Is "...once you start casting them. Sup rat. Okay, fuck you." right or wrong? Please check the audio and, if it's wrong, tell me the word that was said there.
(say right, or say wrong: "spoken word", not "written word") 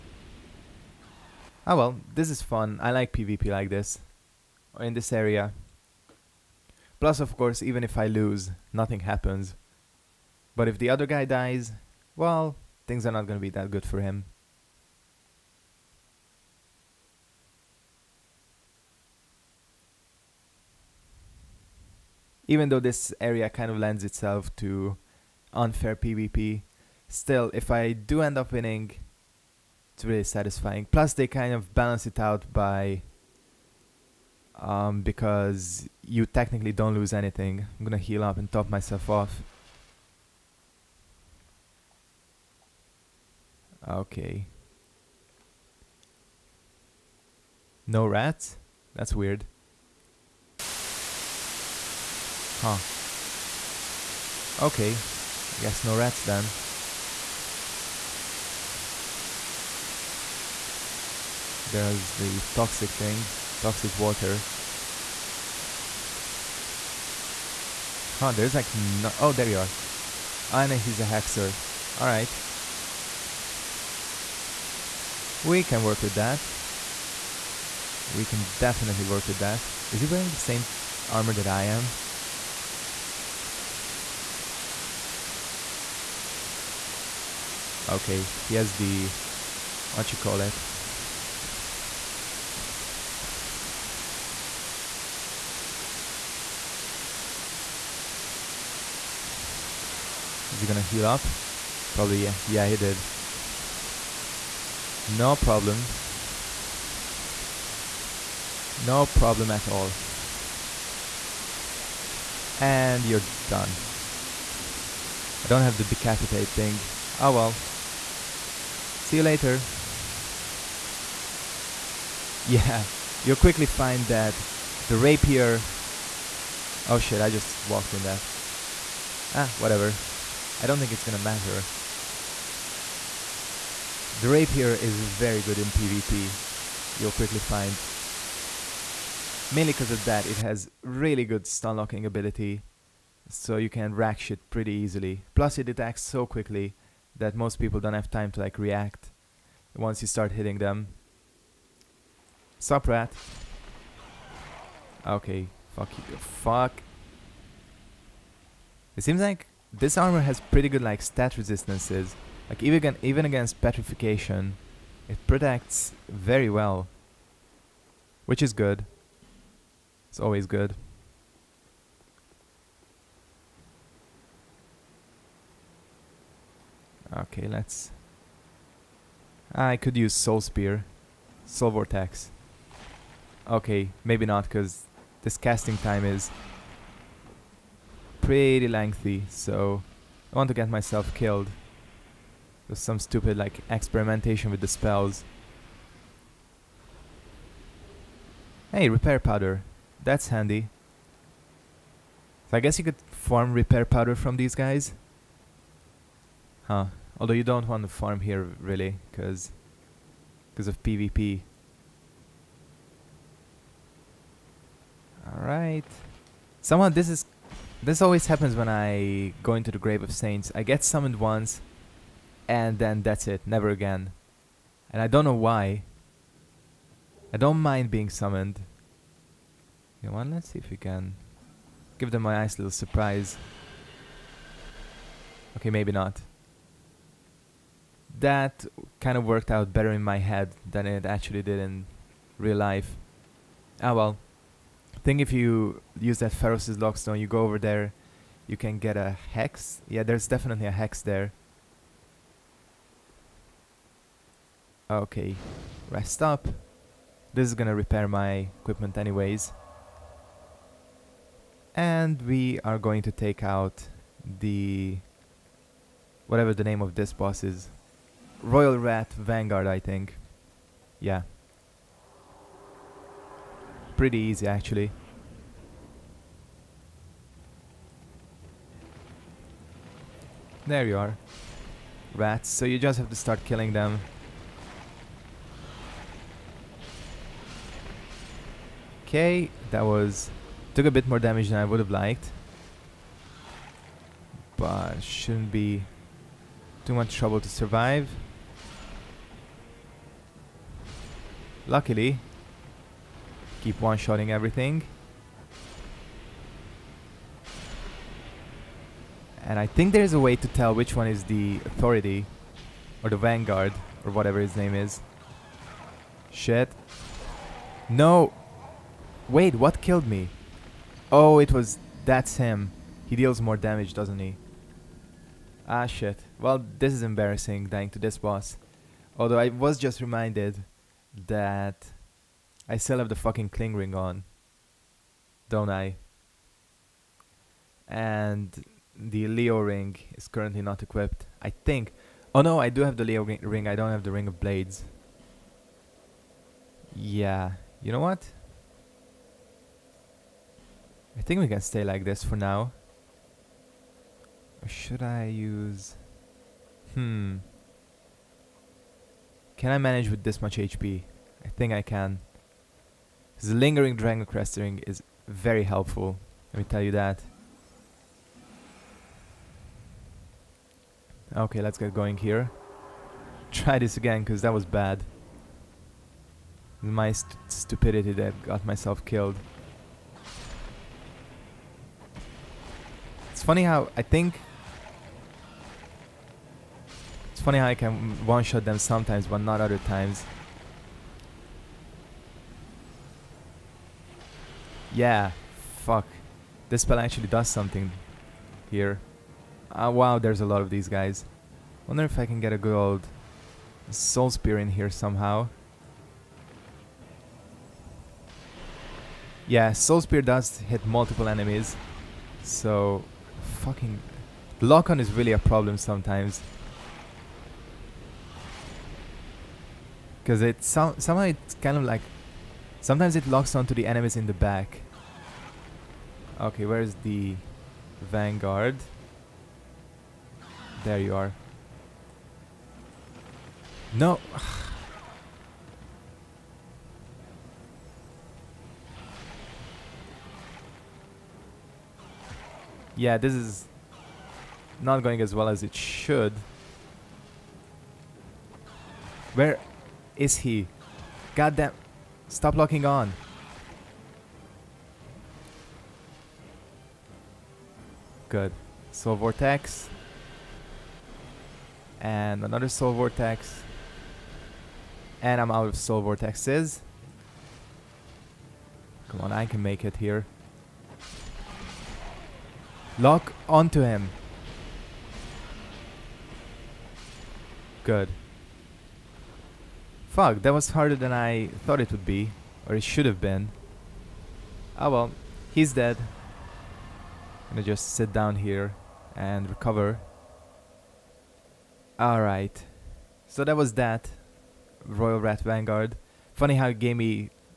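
wrong: "hitting", not "casting".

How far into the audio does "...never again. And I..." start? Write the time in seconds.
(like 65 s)
223 s.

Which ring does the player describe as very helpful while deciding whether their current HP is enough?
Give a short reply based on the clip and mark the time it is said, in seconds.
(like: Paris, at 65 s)
Lingering Dragoncrest Ring, at 363 s.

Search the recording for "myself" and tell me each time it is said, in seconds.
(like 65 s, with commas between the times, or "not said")
38 s, 190 s, 378 s.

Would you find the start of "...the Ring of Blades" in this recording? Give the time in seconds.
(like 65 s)
344 s.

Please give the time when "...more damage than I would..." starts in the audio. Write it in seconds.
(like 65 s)
291 s.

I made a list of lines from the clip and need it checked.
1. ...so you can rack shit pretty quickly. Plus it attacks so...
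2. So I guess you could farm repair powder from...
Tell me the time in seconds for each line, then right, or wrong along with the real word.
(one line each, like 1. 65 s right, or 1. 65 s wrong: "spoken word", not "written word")
1. 143 s wrong: "easily", not "quickly"
2. 202 s right.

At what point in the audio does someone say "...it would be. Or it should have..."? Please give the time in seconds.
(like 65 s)
481 s.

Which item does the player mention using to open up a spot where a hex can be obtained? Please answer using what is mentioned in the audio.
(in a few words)
Pharos' Lockstone.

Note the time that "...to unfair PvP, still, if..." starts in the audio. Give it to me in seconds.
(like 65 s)
24 s.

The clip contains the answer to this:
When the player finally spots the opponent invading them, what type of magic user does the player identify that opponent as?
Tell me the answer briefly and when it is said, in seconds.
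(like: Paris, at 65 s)
Hexer, at 70 s.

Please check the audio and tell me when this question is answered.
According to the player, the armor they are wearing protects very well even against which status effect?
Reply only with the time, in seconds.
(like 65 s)
163 s.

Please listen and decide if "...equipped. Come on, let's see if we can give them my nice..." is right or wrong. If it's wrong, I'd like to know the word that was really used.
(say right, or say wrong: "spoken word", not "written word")
wrong: "summoned", not "equipped".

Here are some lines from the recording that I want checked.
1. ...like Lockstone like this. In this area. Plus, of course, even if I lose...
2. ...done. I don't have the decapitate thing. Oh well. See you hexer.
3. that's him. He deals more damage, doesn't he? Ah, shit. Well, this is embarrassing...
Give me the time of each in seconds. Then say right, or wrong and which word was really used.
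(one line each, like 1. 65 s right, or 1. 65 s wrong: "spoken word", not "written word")
1. 2 s wrong: "PvP", not "Lockstone"
2. 113 s wrong: "later", not "hexer"
3. 322 s right.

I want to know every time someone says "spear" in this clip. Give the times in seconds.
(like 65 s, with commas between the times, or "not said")
180 s, 404 s, 410 s.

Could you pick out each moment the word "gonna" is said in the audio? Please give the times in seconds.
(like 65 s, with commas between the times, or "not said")
13 s, 37 s, 100 s, 131 s, 257 s, 487 s.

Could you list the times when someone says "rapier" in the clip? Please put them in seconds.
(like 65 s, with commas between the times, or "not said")
124 s, 134 s.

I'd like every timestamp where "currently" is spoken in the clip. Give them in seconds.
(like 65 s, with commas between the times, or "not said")
340 s.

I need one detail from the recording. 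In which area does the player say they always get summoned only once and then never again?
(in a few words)
Grave of Saints.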